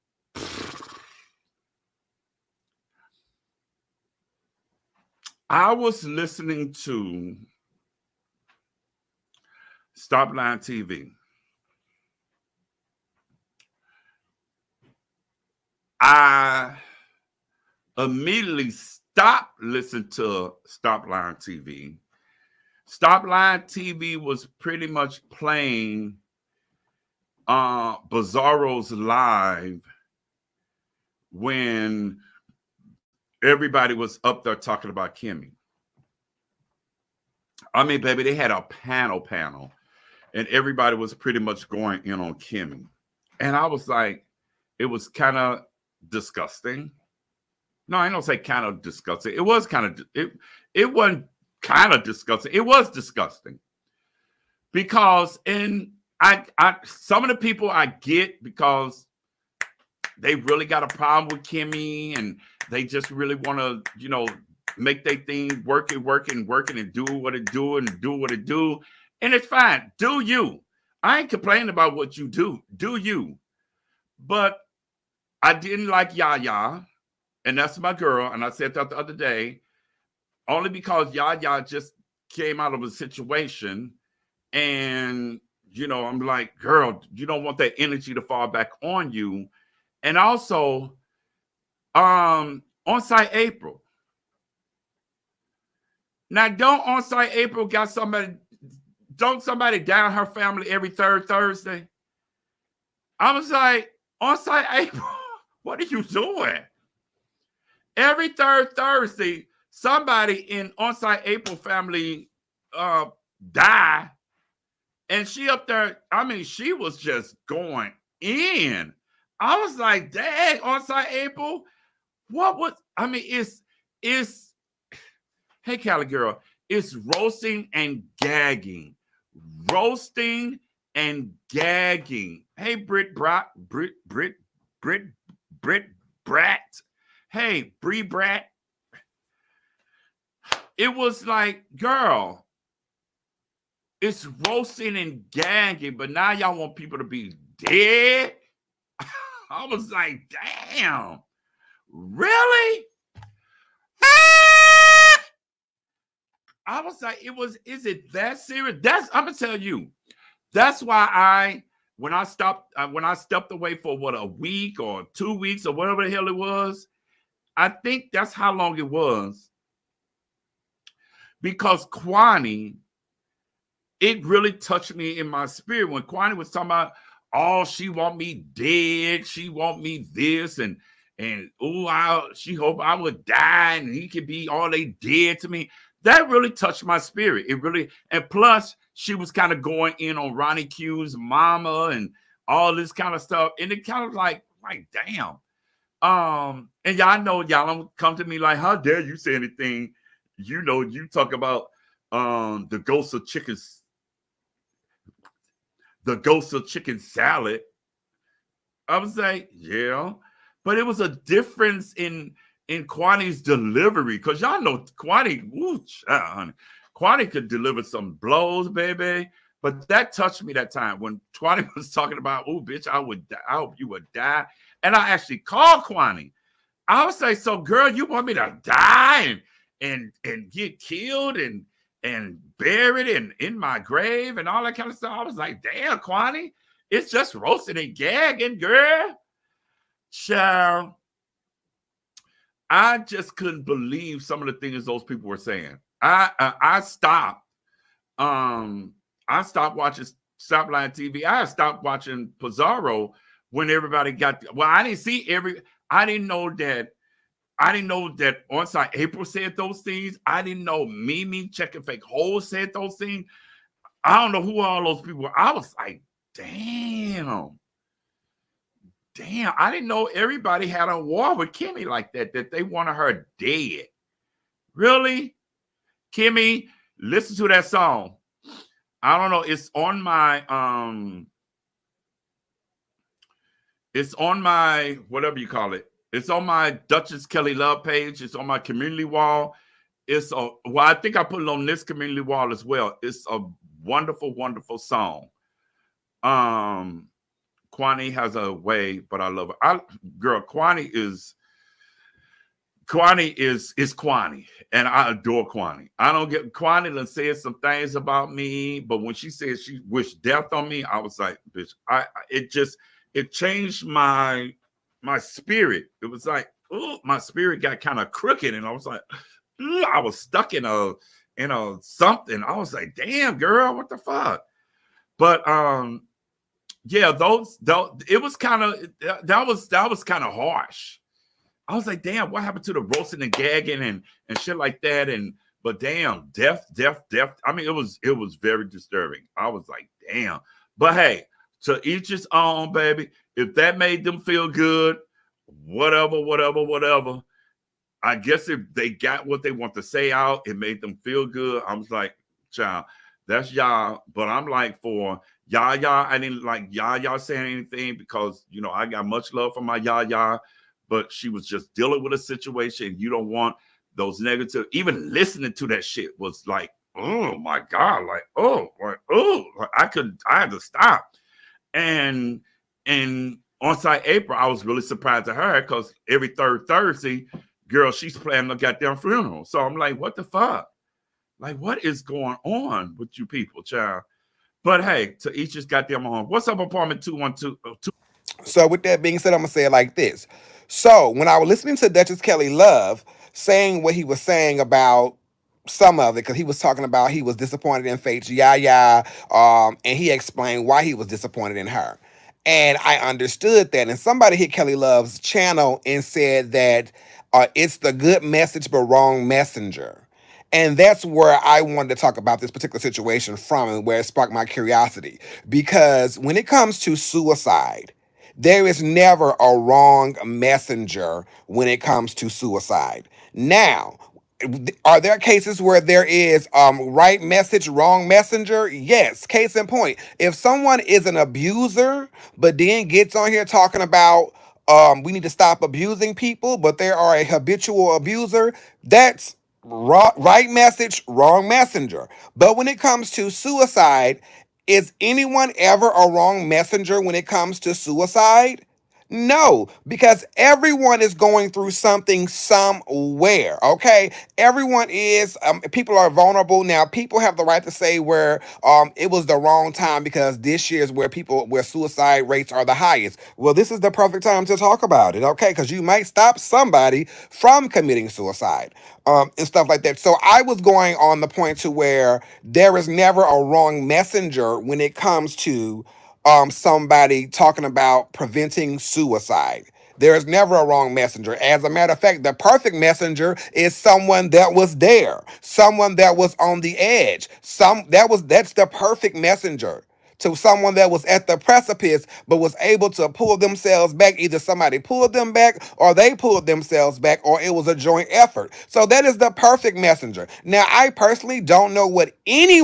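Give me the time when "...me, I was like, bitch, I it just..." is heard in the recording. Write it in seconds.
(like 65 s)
310 s.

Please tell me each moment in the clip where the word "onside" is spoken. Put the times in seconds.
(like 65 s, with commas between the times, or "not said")
120 s, 258 s.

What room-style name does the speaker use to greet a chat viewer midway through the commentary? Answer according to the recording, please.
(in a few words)
Apartment 212.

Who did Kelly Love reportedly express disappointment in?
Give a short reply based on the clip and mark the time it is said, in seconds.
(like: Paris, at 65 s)
Faith Yaya, at 397 s.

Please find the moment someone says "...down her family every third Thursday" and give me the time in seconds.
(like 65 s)
99 s.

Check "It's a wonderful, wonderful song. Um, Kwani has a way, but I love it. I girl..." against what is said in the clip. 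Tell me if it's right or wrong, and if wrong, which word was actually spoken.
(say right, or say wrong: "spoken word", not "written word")
right.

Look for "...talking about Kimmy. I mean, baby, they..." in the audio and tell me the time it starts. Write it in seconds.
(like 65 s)
34 s.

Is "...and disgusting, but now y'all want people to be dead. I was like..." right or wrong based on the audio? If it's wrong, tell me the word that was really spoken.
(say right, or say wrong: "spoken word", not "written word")
wrong: "gagging", not "disgusting".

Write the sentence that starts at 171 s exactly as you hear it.
Because Kwani, it really touched me in my spirit when Kwani was talking about oh, she want me dead.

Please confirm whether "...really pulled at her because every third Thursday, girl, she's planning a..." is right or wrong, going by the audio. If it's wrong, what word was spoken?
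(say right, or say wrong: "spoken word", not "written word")
wrong: "surprised", not "pulled".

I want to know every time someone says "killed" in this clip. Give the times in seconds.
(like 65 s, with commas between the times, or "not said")
230 s.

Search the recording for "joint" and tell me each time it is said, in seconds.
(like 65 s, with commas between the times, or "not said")
497 s.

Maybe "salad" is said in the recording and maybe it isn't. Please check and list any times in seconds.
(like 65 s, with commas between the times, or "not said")
206 s.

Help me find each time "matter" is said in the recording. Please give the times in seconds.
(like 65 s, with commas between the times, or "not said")
481 s.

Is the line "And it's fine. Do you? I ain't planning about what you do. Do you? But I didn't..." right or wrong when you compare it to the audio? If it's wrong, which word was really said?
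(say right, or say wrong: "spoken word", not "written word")
wrong: "complaining", not "planning".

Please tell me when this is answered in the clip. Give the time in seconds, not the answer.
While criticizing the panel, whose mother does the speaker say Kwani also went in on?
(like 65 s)
190 s.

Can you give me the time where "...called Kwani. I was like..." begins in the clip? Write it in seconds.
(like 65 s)
225 s.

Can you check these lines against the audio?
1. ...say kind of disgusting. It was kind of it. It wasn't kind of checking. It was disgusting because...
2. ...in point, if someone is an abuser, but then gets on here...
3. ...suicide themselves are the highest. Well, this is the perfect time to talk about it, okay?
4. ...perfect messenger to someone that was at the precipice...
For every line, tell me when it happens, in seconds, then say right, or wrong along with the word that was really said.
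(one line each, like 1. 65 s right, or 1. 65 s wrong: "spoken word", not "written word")
1. 48 s wrong: "disgusting", not "checking"
2. 429 s right
3. 461 s wrong: "rates", not "themselves"
4. 488 s right.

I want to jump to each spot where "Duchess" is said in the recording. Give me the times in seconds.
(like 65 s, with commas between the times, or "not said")
286 s, 391 s.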